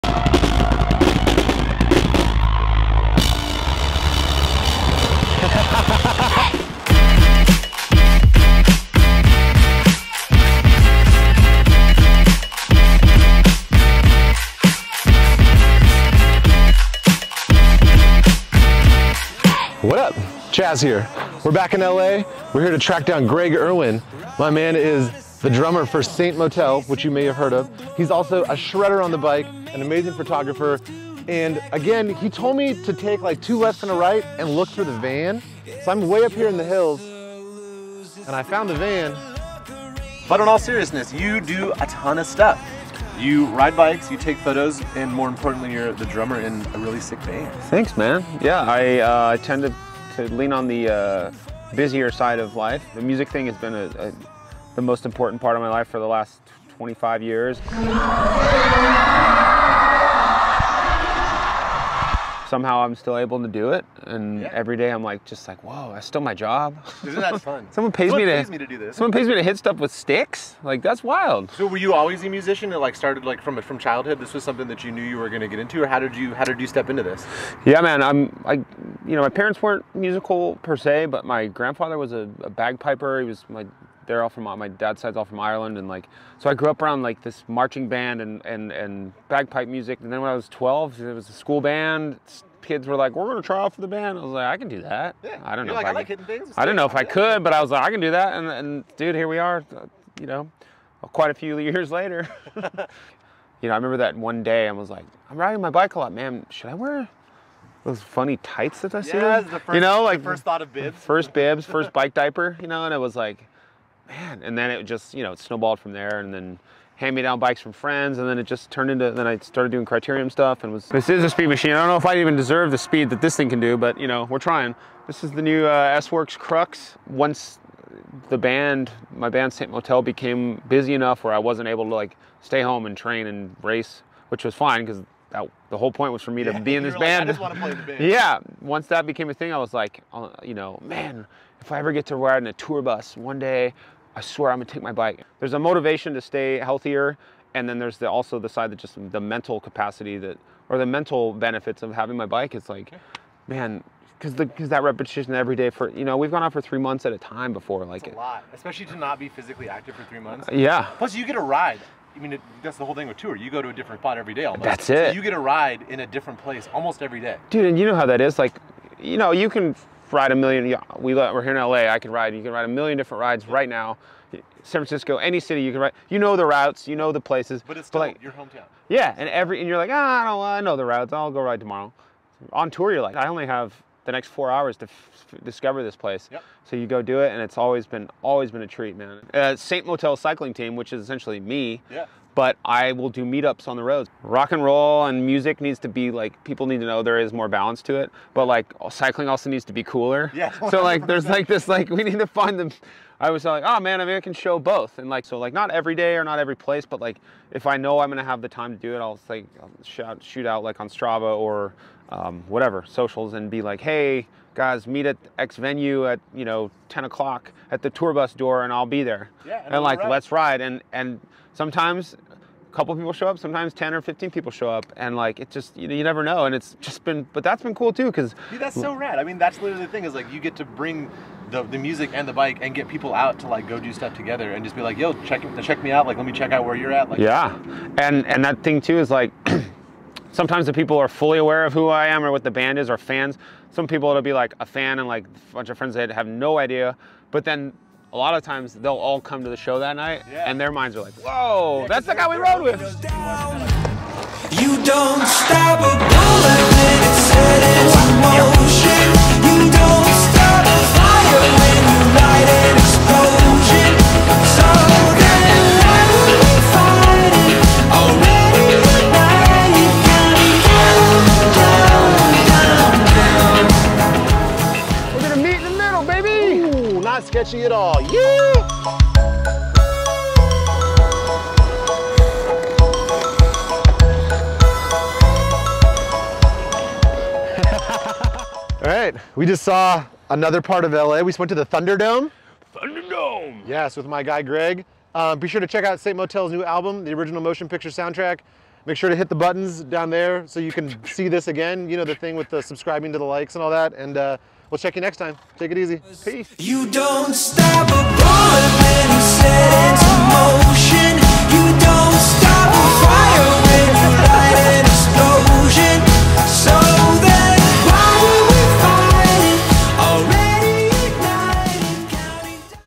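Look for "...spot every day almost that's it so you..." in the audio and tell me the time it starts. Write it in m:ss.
2:43.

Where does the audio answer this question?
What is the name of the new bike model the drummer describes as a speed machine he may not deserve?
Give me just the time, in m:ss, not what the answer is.
2:05.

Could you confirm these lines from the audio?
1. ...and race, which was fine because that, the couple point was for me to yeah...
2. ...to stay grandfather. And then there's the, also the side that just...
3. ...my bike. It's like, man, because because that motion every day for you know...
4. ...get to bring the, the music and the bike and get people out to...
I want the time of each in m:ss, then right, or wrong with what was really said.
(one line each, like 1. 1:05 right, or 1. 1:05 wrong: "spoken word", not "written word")
1. 2:13 wrong: "whole", not "couple"
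2. 2:26 wrong: "healthier", not "grandfather"
3. 2:32 wrong: "repetition", not "motion"
4. 3:50 right.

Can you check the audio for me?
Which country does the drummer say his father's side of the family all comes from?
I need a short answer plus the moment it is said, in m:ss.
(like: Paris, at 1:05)
Ireland, at 1:25.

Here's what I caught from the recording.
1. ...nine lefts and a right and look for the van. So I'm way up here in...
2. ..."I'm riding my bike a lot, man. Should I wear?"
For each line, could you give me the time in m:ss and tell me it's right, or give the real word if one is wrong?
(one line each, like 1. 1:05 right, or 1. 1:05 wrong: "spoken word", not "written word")
1. 0:33 wrong: "two", not "nine"
2. 1:45 right.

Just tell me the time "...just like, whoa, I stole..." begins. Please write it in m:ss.
1:05.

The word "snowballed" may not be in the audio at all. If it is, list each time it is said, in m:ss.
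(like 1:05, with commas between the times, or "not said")
1:55.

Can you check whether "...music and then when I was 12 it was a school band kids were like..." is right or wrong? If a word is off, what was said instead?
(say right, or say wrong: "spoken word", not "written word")
right.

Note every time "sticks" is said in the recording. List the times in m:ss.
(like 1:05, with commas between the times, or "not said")
1:09.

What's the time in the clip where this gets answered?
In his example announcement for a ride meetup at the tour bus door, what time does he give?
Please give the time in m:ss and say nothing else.
3:36.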